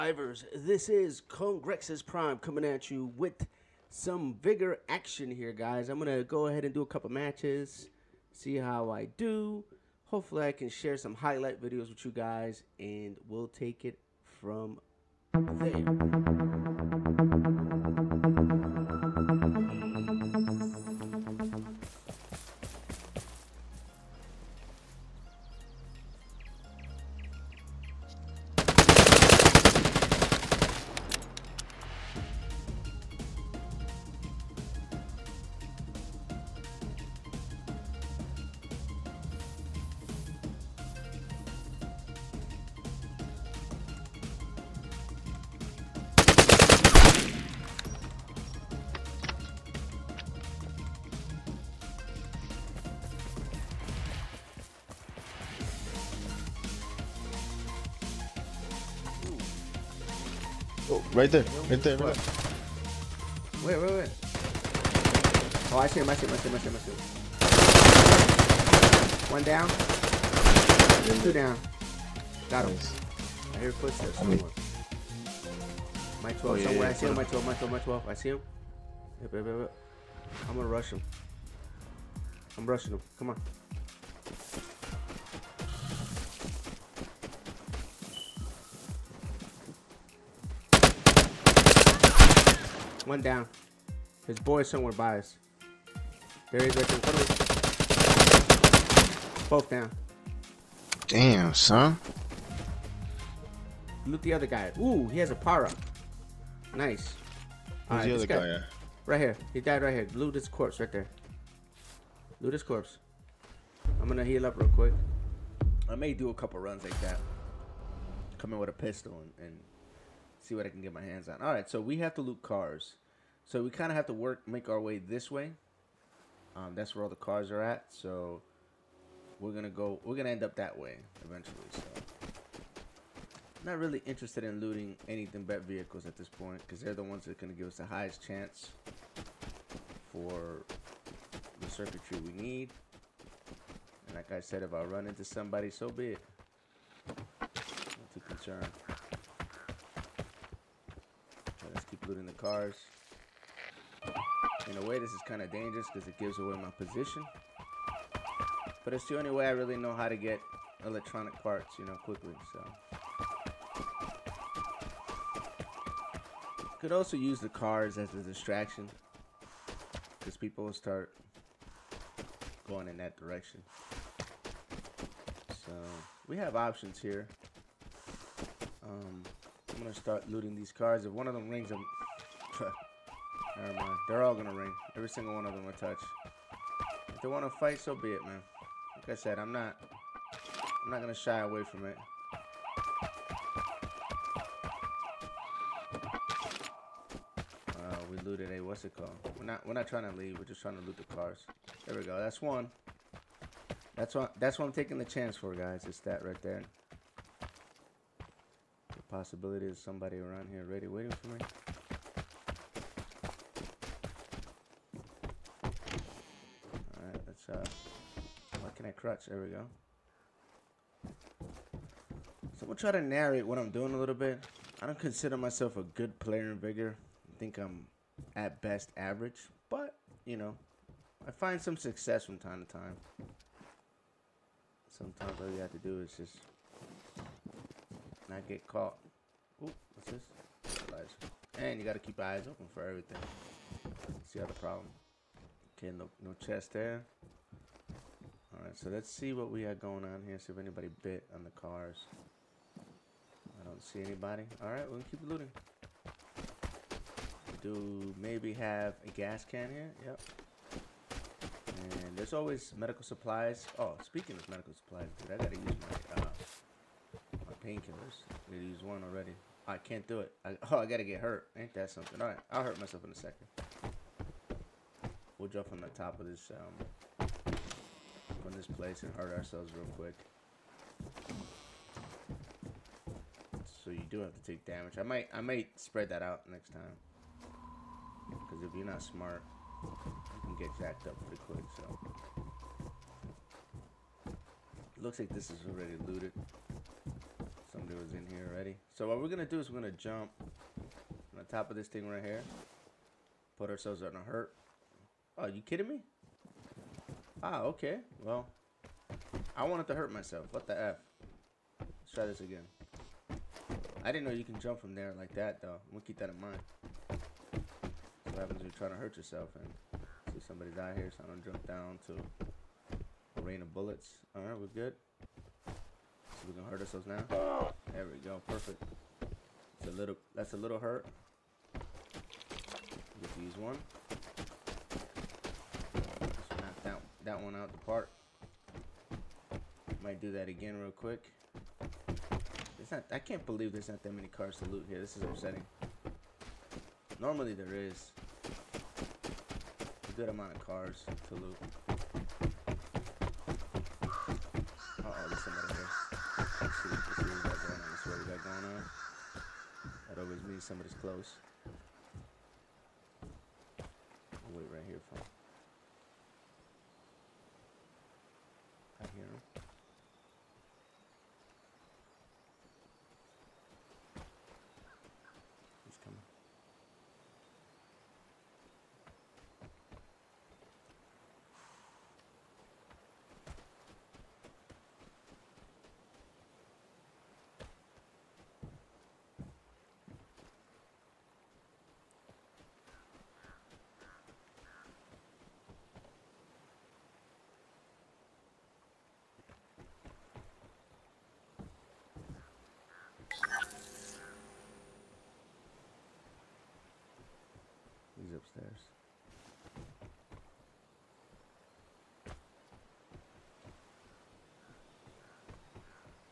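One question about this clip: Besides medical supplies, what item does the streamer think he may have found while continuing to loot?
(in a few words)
A gas can.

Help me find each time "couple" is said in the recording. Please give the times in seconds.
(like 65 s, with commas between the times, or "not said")
6 s, 116 s.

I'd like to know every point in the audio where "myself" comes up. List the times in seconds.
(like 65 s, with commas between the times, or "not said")
225 s, 272 s, 310 s.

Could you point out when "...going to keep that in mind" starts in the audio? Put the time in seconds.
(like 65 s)
315 s.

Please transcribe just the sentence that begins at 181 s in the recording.
If one of them rings, I'm...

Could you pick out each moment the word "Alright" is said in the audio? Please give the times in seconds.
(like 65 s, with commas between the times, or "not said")
121 s, 248 s, 254 s, 272 s.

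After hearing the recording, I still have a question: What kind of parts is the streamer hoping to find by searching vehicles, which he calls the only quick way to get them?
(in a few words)
Electronic parts.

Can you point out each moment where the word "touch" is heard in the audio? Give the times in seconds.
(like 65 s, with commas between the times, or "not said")
185 s.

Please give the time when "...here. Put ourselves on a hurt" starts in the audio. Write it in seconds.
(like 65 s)
302 s.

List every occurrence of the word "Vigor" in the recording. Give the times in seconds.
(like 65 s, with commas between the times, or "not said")
4 s, 226 s.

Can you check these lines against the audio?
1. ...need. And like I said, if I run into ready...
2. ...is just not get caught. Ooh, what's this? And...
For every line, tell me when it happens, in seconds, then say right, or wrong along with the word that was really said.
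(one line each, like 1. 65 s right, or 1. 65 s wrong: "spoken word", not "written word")
1. 142 s wrong: "somebody", not "ready"
2. 236 s right.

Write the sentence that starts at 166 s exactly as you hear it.
Could also use the cars as a distraction.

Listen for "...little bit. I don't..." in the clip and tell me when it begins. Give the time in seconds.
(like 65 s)
223 s.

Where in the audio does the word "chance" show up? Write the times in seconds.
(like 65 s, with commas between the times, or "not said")
138 s, 205 s.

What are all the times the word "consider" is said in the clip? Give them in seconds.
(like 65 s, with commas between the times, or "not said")
224 s.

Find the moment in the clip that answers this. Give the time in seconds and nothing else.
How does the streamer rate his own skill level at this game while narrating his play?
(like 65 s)
228 s.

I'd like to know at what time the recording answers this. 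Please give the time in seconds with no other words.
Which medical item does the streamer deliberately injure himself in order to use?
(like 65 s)
267 s.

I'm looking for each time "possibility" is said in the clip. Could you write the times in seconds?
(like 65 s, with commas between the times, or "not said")
209 s.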